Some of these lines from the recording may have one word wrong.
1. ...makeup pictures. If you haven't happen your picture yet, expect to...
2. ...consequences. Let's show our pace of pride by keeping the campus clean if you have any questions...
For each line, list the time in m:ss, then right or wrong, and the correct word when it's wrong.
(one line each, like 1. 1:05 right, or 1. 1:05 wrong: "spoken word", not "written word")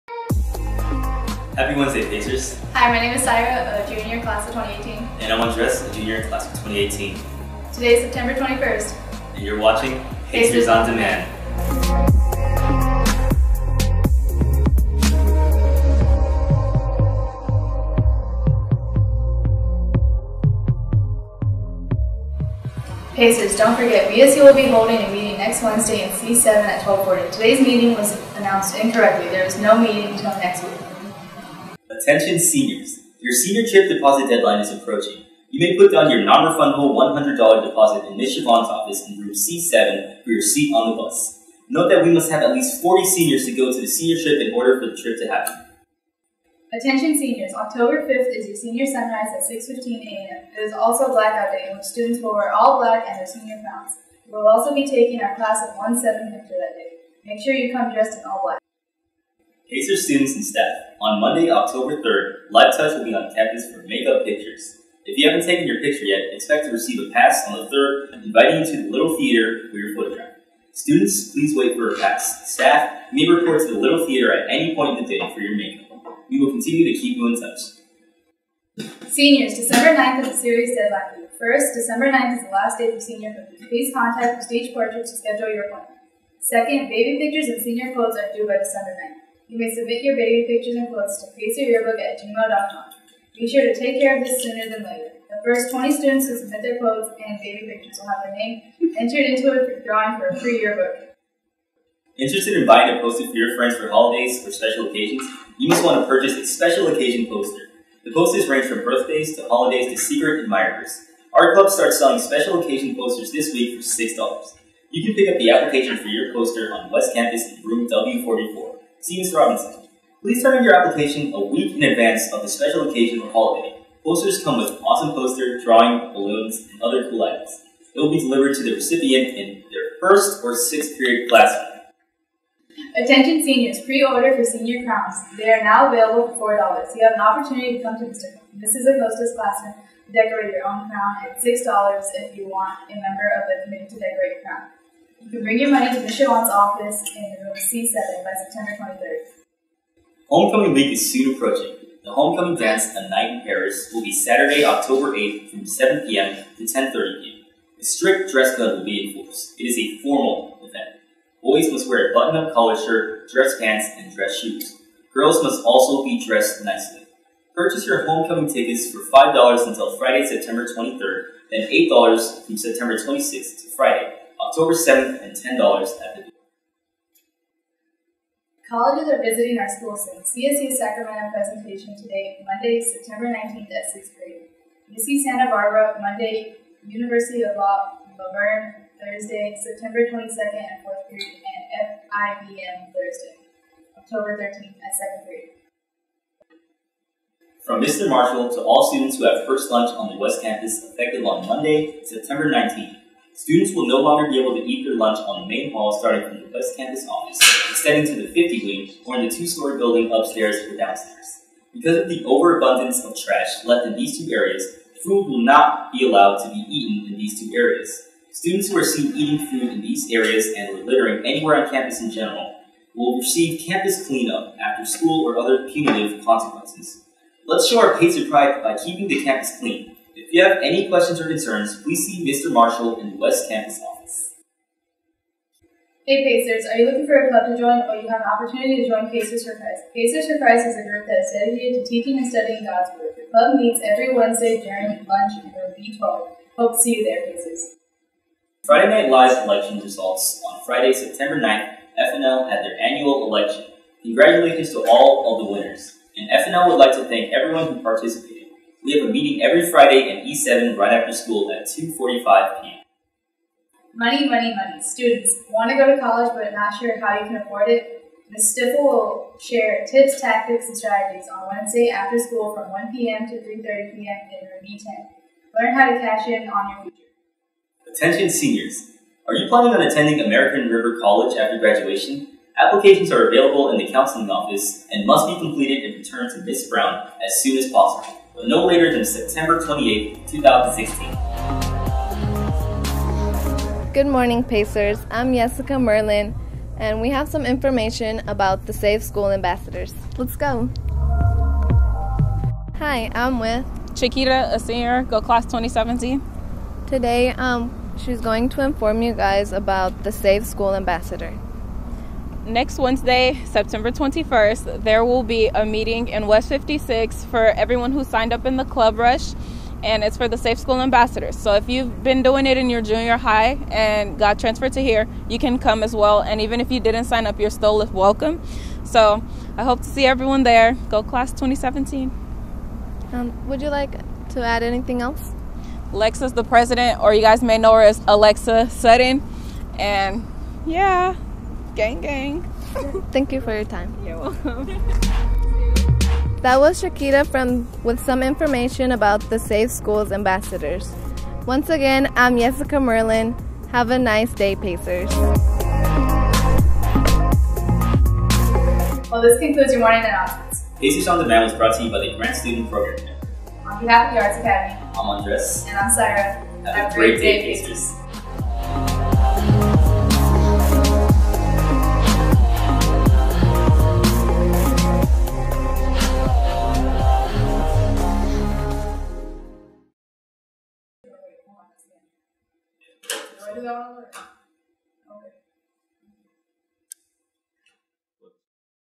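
1. 1:03 wrong: "taken", not "happen"
2. 3:46 right.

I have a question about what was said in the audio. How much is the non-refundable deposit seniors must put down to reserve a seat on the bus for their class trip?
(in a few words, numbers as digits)
$100.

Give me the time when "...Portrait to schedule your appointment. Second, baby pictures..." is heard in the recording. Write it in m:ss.
1:24.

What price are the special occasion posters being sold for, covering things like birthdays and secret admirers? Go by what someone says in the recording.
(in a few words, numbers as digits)
$6.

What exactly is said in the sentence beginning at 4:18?
We have a meeting every Friday in E7 right after school at 2.45 p.m.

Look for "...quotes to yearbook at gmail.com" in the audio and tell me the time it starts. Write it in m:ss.
1:30.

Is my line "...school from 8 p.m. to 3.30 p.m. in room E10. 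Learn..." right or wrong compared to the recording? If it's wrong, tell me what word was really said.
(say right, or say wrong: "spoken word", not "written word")
wrong: "1", not "8".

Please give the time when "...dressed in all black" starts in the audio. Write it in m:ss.
0:57.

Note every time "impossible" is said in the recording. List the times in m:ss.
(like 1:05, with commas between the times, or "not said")
not said.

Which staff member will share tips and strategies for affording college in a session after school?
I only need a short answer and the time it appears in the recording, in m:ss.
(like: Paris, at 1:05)
Ms. Stiffel, at 4:28.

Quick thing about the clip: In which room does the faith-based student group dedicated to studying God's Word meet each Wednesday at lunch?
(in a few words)
B12.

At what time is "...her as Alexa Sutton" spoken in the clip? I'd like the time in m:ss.
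5:37.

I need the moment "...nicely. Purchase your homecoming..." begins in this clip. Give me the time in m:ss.
2:46.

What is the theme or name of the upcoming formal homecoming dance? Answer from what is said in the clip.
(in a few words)
A Night in Paris.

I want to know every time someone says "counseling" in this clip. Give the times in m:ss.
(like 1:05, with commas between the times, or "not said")
4:43.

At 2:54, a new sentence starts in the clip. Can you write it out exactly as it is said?
October 7th and $10 at the door.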